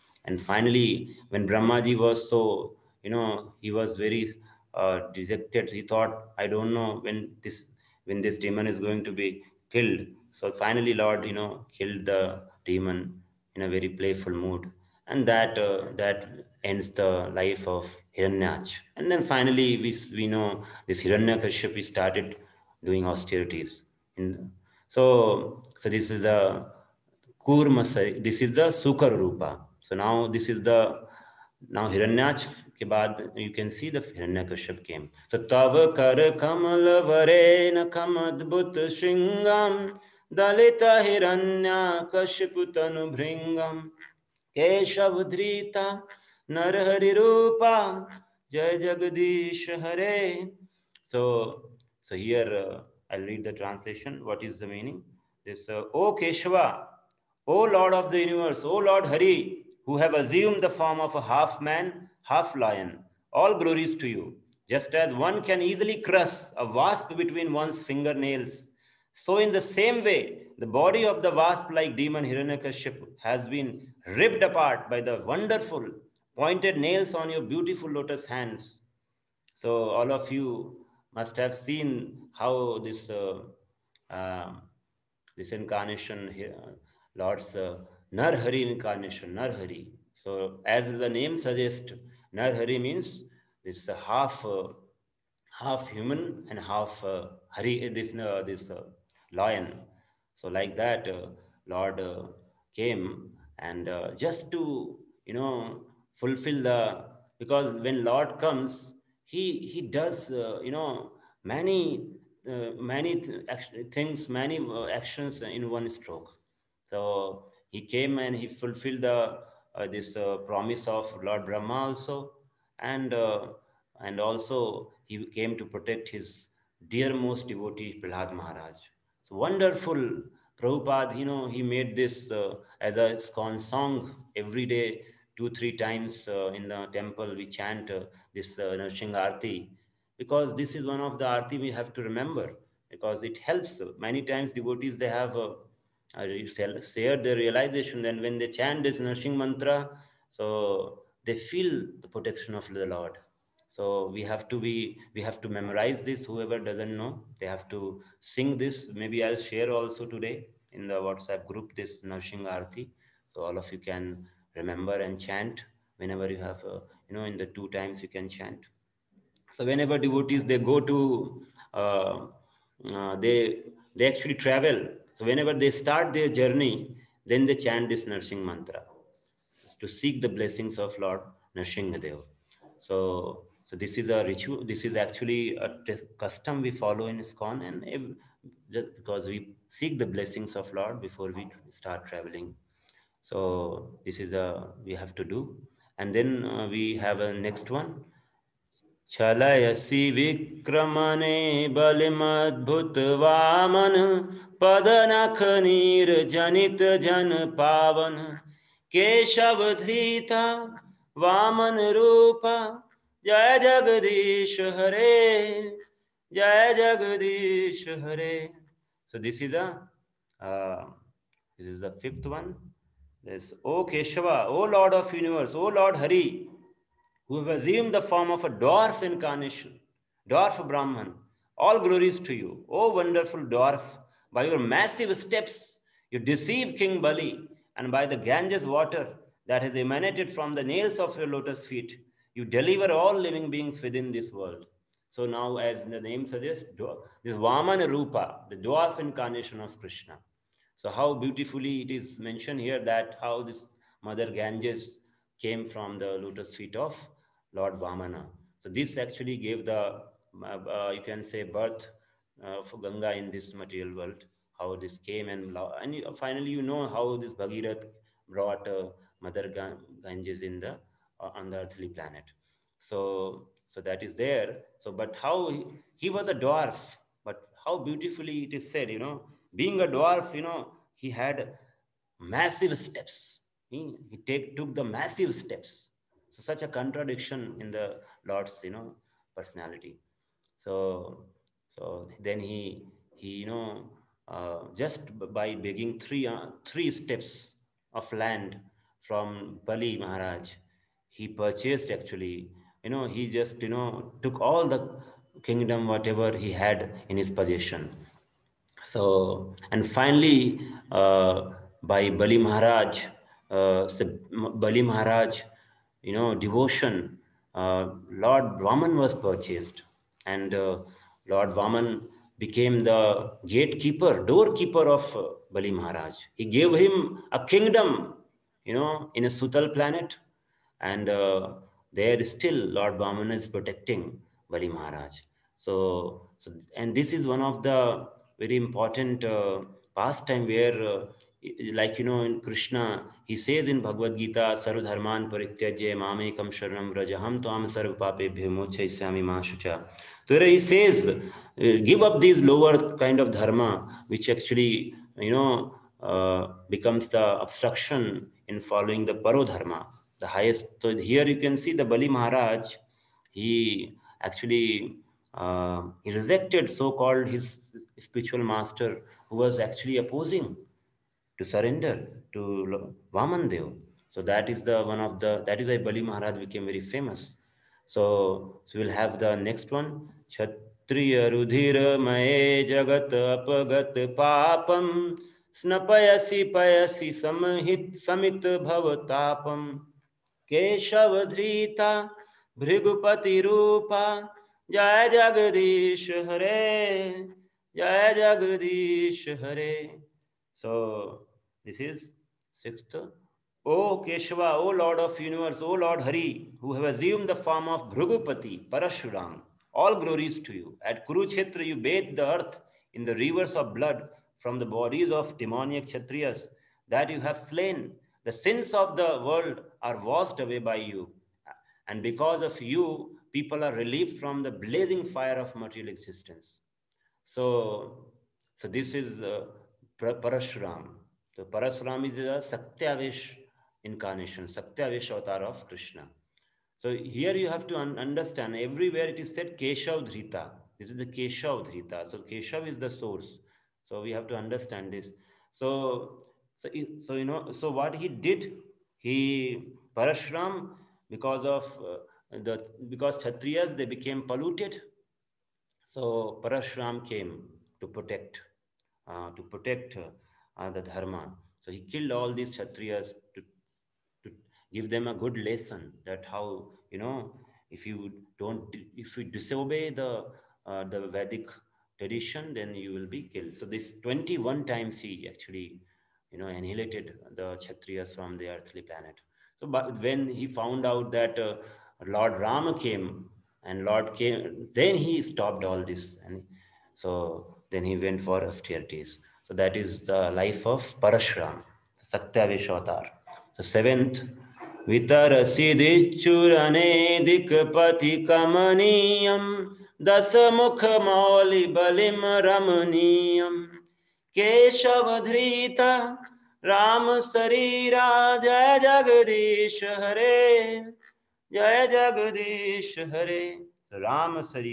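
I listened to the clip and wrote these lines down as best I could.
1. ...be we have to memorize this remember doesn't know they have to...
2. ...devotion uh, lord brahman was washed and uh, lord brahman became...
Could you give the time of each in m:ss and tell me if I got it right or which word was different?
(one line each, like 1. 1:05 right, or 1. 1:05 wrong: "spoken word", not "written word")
1. 2:34 wrong: "whoever", not "remember"
2. 5:16 wrong: "purchased", not "washed".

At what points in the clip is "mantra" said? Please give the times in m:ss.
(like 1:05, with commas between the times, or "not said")
2:29, 2:58.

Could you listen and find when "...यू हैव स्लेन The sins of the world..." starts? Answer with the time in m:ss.
6:57.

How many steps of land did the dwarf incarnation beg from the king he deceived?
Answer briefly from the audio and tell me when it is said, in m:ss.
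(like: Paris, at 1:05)
3, at 4:56.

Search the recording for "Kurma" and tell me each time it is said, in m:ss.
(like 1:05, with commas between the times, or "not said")
0:27.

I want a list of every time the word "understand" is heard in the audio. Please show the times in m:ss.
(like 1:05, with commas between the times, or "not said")
7:17, 7:24.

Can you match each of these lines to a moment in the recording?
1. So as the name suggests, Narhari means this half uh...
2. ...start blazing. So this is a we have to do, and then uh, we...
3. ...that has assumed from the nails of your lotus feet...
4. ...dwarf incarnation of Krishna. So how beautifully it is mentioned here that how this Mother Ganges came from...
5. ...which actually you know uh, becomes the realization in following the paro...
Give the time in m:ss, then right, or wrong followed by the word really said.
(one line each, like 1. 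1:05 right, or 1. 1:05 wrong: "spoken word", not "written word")
1. 1:30 right
2. 3:11 wrong: "traveling", not "blazing"
3. 3:59 wrong: "emanated", not "assumed"
4. 4:08 right
5. 5:54 wrong: "obstruction", not "realization".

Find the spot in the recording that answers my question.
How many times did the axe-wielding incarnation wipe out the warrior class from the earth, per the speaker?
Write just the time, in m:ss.
7:54.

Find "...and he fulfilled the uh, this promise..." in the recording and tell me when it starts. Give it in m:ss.
1:58.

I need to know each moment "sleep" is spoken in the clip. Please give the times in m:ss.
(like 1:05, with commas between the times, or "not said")
not said.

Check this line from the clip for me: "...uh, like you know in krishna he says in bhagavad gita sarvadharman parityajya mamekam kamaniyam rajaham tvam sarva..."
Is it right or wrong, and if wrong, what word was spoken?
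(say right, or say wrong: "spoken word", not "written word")
wrong: "sharanam", not "kamaniyam".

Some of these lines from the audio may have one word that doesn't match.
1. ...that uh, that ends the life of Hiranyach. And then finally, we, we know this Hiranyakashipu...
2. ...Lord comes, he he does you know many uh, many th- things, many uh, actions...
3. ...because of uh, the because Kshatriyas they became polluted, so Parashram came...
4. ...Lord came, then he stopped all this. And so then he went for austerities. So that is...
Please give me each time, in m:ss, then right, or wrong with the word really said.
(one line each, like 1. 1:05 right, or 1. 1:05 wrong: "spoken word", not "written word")
1. 0:15 right
2. 1:48 right
3. 7:31 right
4. 8:03 right.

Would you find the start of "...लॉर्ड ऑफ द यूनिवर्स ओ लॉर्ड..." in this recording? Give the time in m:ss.
0:57.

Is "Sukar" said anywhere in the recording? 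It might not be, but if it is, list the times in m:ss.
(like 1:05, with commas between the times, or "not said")
0:28.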